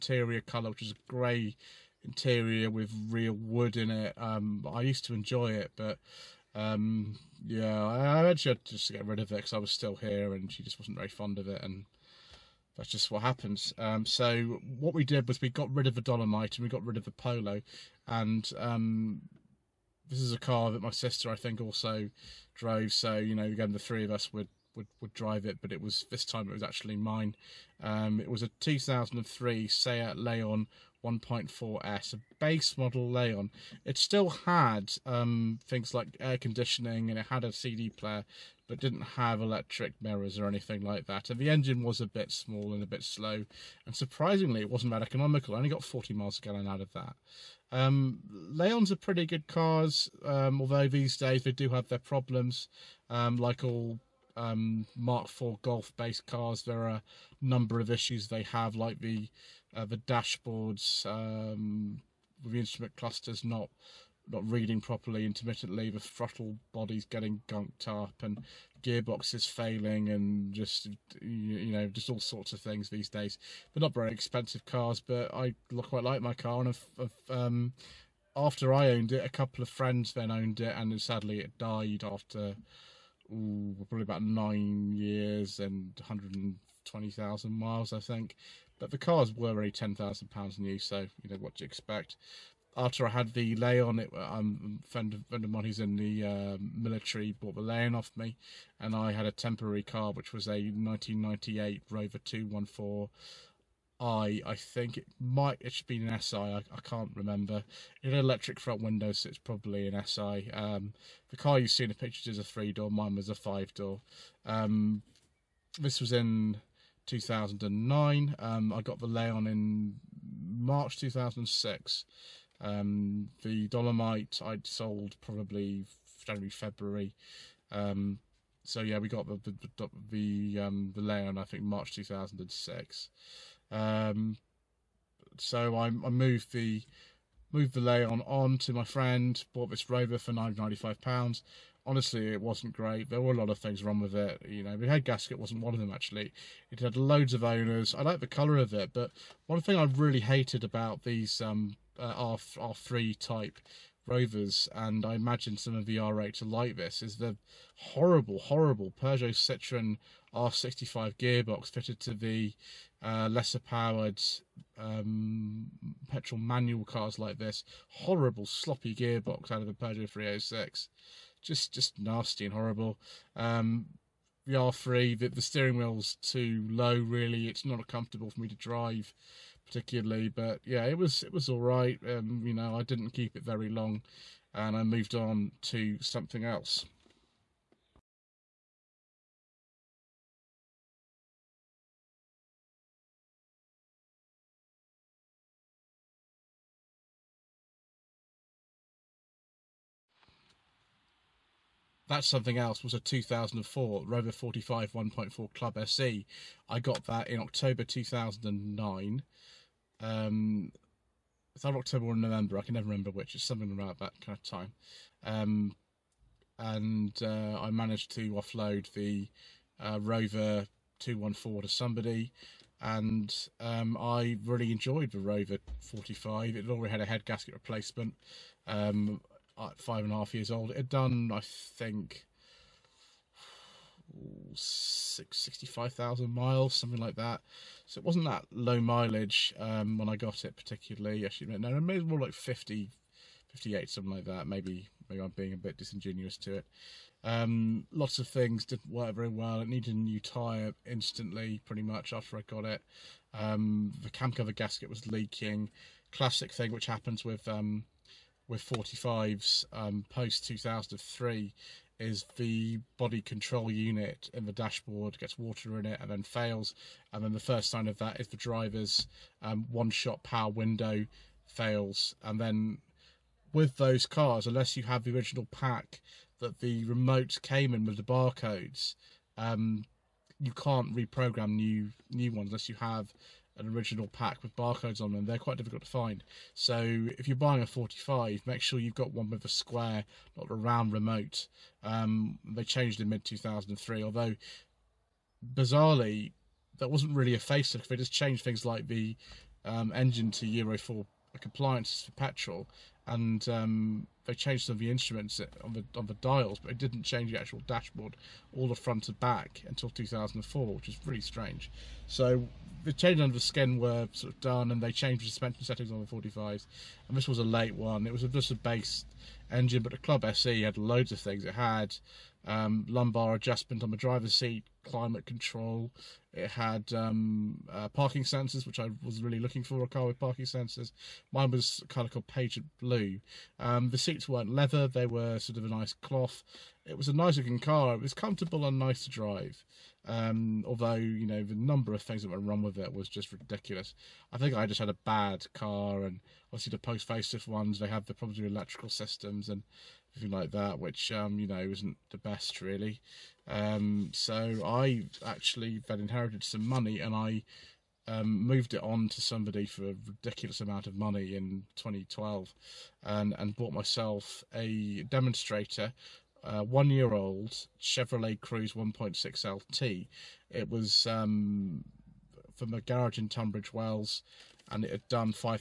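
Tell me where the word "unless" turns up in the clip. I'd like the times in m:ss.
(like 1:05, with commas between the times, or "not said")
4:34, 4:42.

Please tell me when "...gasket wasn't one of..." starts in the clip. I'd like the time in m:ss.
2:25.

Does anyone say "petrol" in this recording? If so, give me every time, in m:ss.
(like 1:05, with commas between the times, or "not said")
2:46, 5:02.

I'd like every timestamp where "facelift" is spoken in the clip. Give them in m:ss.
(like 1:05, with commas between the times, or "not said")
4:57, 5:47.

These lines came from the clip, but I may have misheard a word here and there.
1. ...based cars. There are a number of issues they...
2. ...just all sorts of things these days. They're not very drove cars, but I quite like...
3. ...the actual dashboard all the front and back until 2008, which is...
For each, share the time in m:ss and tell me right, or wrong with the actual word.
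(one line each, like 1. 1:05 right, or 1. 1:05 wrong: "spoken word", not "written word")
1. 0:55 right
2. 1:11 wrong: "expensive", not "drove"
3. 5:07 wrong: "2004", not "2008".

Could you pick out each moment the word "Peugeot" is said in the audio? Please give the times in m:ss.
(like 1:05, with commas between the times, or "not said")
2:39, 2:49.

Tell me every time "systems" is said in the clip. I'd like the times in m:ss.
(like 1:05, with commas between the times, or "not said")
5:48.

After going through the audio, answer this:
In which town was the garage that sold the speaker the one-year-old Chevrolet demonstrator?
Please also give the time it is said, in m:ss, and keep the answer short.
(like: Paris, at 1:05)
Tunbridge Wells, at 6:13.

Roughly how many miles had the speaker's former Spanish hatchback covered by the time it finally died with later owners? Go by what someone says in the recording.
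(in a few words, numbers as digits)
120,000.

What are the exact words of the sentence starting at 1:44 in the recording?
I I think it might it should be an SI.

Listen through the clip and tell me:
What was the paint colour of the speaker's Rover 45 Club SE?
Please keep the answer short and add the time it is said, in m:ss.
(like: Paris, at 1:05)
Pageant Blue, at 5:32.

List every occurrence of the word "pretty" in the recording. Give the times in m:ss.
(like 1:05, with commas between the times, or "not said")
0:48, 4:11.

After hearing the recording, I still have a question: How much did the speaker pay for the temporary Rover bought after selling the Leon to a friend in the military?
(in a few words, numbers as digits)
995 pounds.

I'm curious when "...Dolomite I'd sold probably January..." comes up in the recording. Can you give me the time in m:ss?
2:03.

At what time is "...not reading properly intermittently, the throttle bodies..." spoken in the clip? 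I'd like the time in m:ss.
1:04.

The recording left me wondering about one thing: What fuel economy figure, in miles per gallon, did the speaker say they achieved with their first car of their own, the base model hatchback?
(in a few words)
40.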